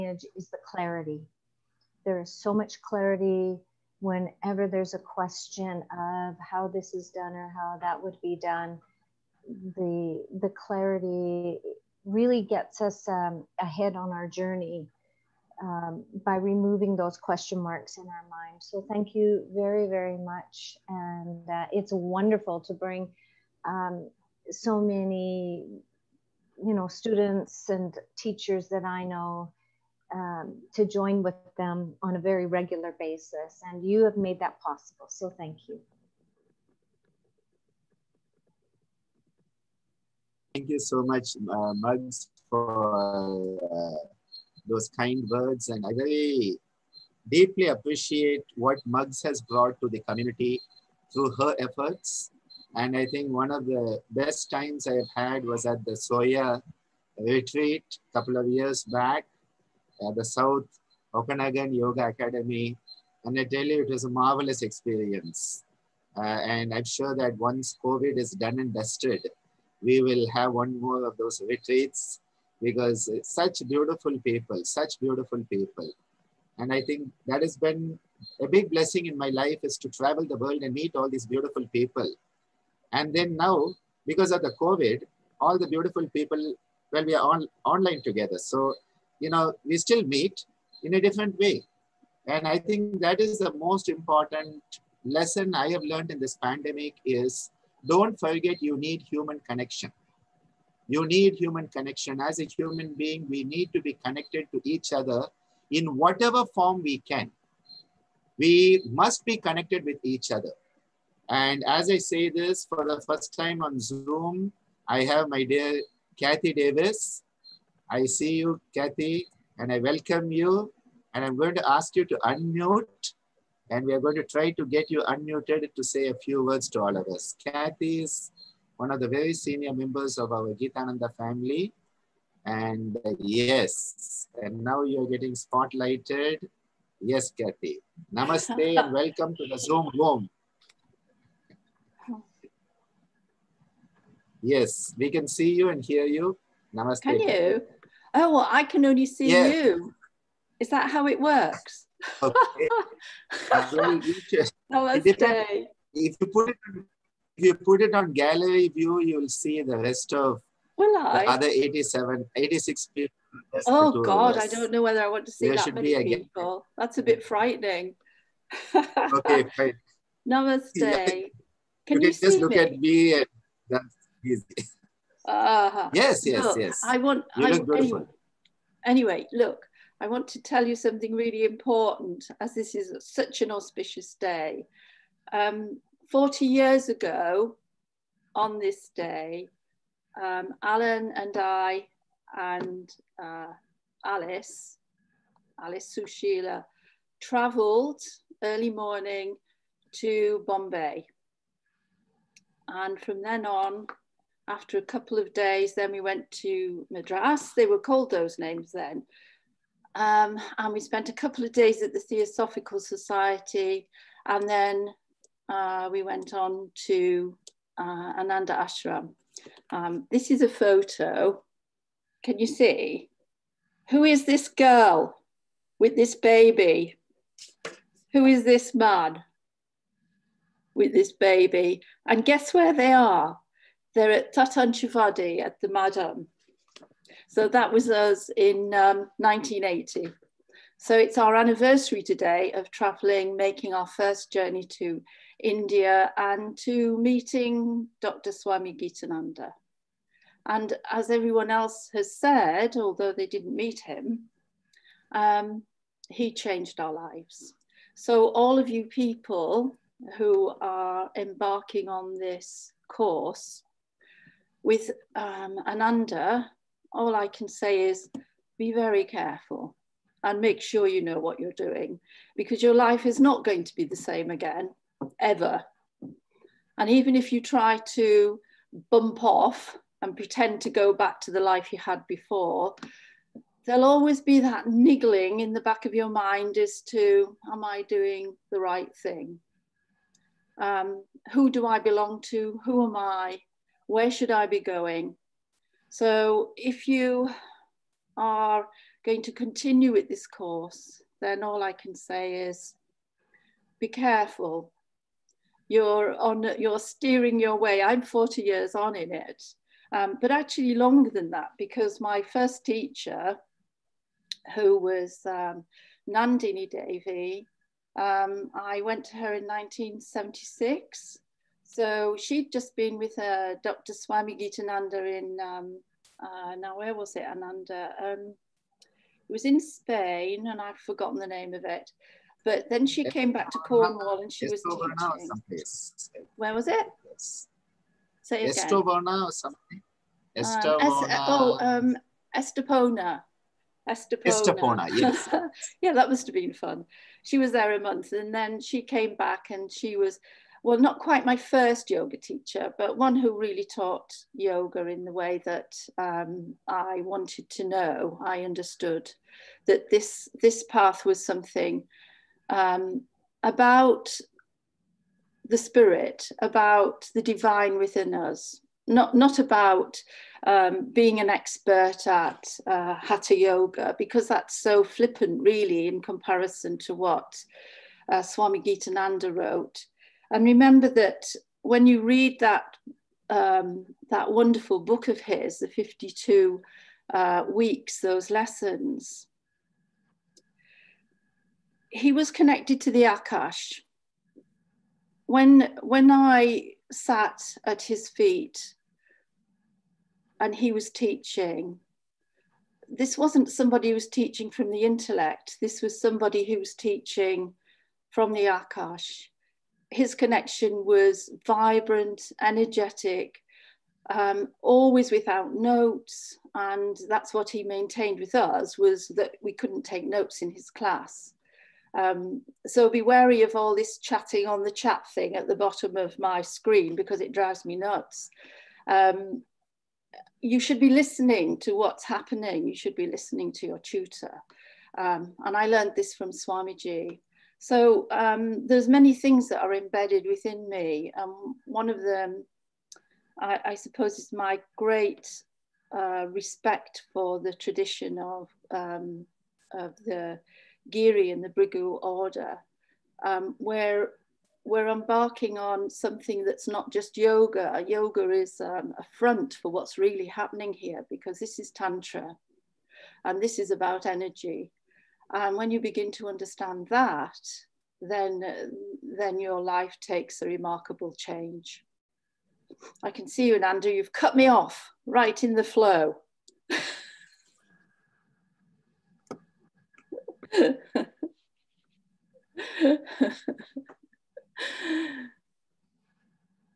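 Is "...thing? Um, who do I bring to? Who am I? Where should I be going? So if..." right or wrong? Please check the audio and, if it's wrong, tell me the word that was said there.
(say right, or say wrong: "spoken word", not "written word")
wrong: "belong", not "bring".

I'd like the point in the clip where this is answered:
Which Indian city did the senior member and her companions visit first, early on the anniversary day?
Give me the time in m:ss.
3:20.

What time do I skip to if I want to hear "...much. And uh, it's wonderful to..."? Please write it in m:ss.
0:20.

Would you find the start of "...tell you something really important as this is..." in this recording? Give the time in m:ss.
3:00.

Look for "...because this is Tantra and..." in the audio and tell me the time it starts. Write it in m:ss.
7:41.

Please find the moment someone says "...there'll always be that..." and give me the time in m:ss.
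4:43.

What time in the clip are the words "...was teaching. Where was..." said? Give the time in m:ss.
5:34.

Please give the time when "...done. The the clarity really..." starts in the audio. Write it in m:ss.
0:08.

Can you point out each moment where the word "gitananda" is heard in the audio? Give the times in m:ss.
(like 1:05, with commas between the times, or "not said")
2:10, 4:08, 5:24, 6:18.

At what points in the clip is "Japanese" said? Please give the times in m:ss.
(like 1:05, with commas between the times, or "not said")
not said.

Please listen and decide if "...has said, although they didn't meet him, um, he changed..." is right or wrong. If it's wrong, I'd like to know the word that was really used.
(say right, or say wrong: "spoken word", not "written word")
right.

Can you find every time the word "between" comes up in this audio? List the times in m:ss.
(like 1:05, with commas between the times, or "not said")
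not said.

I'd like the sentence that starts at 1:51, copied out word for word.
And as I say this for the first time on Zoom, I have my dear Kathy Davis.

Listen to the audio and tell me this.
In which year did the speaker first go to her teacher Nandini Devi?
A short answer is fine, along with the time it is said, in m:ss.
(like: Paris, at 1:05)
1976, at 5:19.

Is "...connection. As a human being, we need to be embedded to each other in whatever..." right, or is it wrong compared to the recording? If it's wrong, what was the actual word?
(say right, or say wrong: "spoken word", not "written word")
wrong: "connected", not "embedded".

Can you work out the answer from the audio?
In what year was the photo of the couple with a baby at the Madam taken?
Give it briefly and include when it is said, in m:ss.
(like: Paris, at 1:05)
1980, at 3:59.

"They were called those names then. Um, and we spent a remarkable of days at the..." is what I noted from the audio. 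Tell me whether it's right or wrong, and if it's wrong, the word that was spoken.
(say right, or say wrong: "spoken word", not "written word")
wrong: "couple", not "remarkable".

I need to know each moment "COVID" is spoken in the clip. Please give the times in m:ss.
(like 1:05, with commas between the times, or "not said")
1:07, 1:24.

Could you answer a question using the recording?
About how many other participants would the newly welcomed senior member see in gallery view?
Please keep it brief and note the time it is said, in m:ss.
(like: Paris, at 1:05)
87, at 2:41.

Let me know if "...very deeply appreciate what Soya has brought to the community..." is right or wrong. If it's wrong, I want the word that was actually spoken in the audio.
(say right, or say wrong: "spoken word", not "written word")
wrong: "Mugs", not "Soya".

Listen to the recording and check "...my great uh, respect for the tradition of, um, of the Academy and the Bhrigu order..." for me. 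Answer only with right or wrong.
wrong.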